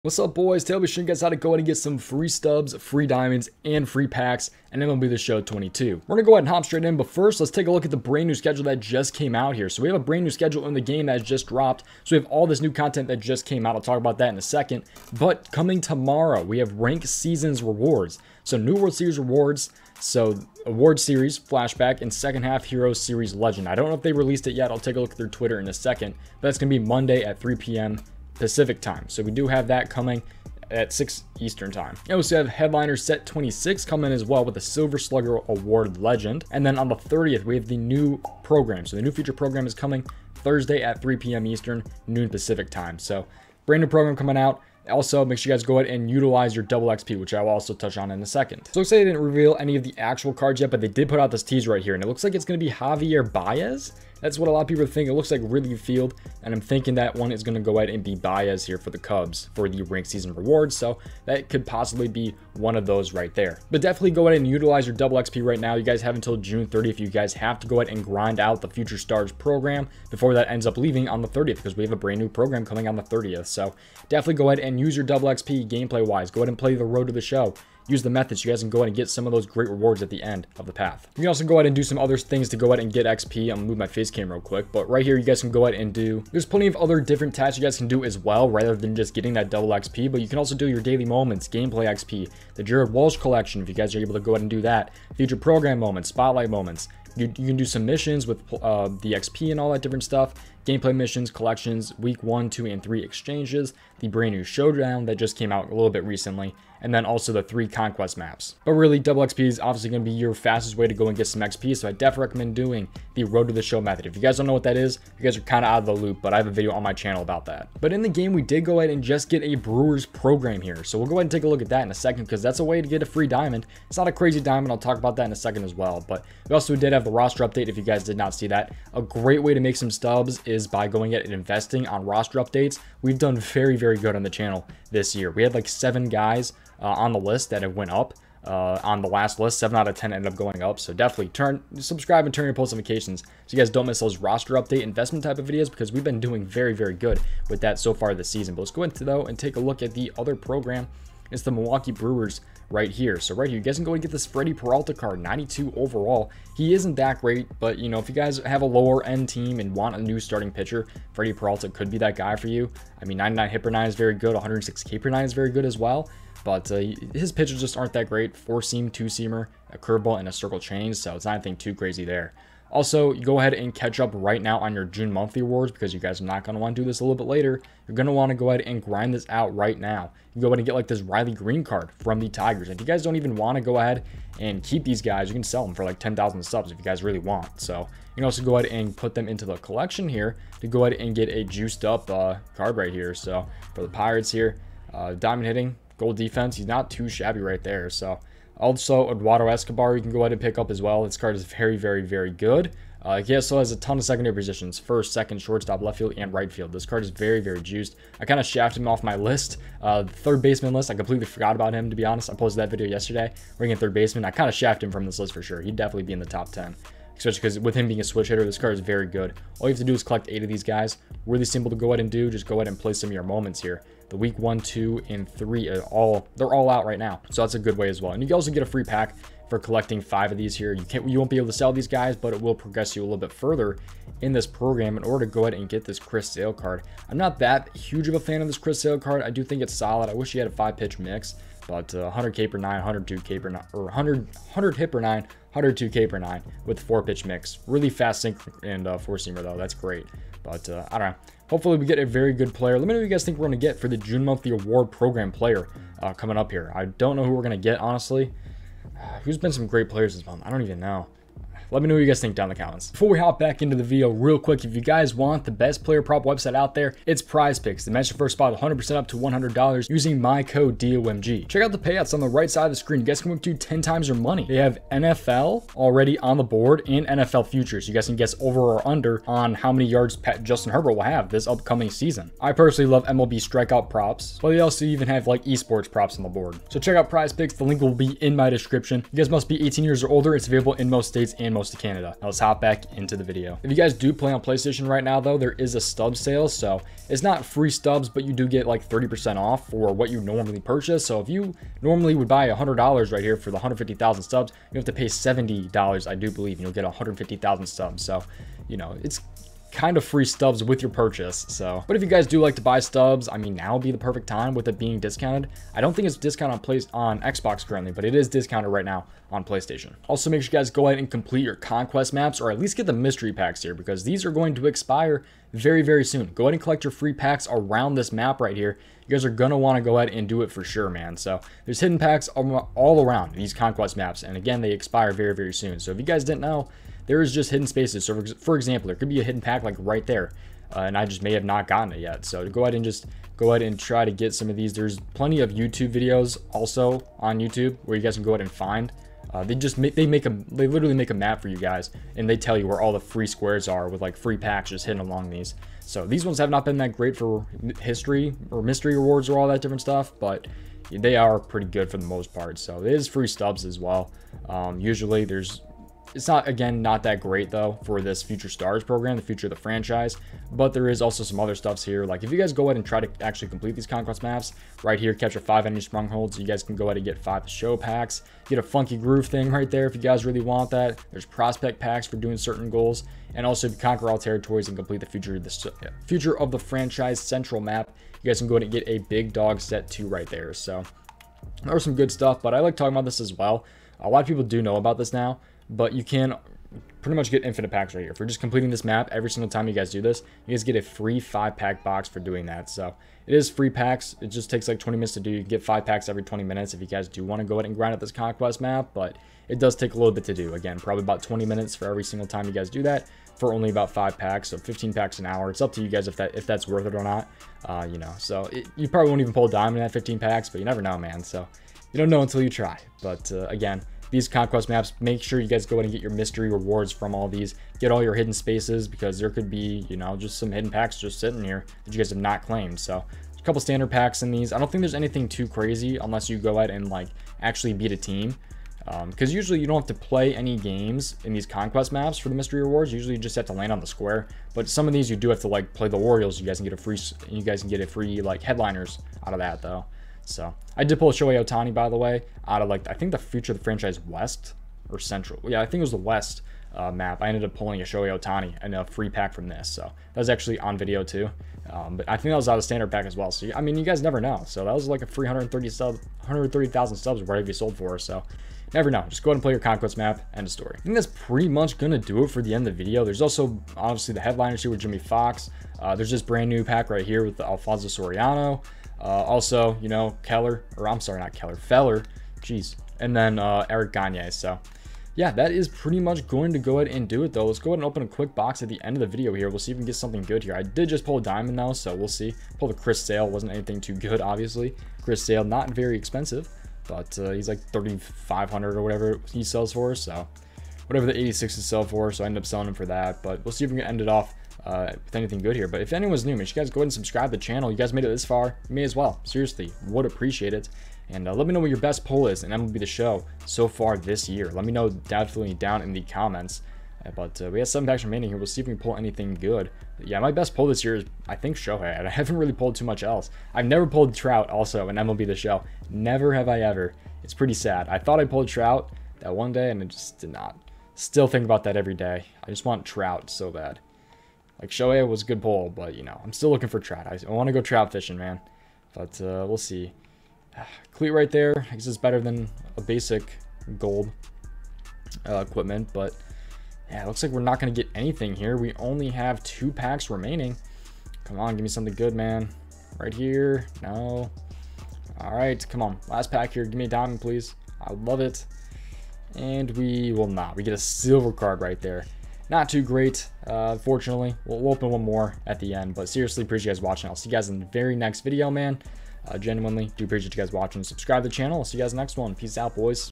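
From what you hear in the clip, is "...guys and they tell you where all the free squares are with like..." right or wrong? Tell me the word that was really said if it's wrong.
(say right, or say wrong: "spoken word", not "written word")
right.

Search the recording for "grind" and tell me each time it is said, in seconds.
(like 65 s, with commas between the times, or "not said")
68 s, 178 s, 407 s.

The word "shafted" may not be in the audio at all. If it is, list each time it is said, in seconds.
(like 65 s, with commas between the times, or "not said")
208 s, 214 s.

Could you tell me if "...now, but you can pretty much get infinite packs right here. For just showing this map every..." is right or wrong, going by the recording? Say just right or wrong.
wrong.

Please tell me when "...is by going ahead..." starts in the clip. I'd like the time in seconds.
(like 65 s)
130 s.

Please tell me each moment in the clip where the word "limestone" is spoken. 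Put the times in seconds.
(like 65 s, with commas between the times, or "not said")
not said.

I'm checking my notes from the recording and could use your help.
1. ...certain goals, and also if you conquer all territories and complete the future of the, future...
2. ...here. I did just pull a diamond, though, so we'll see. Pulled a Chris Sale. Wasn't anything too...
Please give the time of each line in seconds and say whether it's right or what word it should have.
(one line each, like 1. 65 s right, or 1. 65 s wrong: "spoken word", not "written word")
1. 382 s right
2. 490 s right.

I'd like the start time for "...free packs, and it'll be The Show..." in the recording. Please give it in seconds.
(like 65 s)
3 s.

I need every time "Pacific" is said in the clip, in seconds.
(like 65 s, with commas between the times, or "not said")
28 s, 42 s.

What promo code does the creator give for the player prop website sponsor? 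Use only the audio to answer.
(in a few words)
DOMG.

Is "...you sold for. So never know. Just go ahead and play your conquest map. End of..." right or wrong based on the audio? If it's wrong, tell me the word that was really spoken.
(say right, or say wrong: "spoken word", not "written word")
right.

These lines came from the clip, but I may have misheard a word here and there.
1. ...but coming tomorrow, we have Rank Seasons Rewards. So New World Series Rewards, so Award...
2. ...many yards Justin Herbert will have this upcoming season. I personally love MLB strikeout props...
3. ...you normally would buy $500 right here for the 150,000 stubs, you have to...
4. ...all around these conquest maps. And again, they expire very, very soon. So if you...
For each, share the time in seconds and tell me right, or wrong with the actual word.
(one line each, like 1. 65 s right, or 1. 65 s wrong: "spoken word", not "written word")
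1. 15 s right
2. 279 s right
3. 301 s wrong: "100", not "500"
4. 332 s right.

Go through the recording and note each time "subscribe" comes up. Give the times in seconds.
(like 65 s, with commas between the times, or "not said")
141 s, 506 s, 570 s.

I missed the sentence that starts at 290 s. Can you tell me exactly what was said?
It's available in most states and most most of Canada.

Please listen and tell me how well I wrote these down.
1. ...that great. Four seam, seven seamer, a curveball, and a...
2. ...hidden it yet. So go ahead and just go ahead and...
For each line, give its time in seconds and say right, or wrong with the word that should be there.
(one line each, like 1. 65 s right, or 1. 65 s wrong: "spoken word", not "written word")
1. 167 s wrong: "two", not "seven"
2. 341 s wrong: "gotten", not "hidden".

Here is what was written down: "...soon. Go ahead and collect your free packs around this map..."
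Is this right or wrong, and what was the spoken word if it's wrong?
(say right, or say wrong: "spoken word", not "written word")
right.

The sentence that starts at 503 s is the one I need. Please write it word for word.
But we'll see if we can end it off uh, with anything good here.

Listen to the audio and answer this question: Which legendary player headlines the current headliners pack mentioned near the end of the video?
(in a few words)
Jimmie Foxx.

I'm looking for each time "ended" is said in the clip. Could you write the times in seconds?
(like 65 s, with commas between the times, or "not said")
140 s, 457 s, 502 s.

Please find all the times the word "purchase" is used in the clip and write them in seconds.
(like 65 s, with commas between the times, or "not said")
300 s, 310 s.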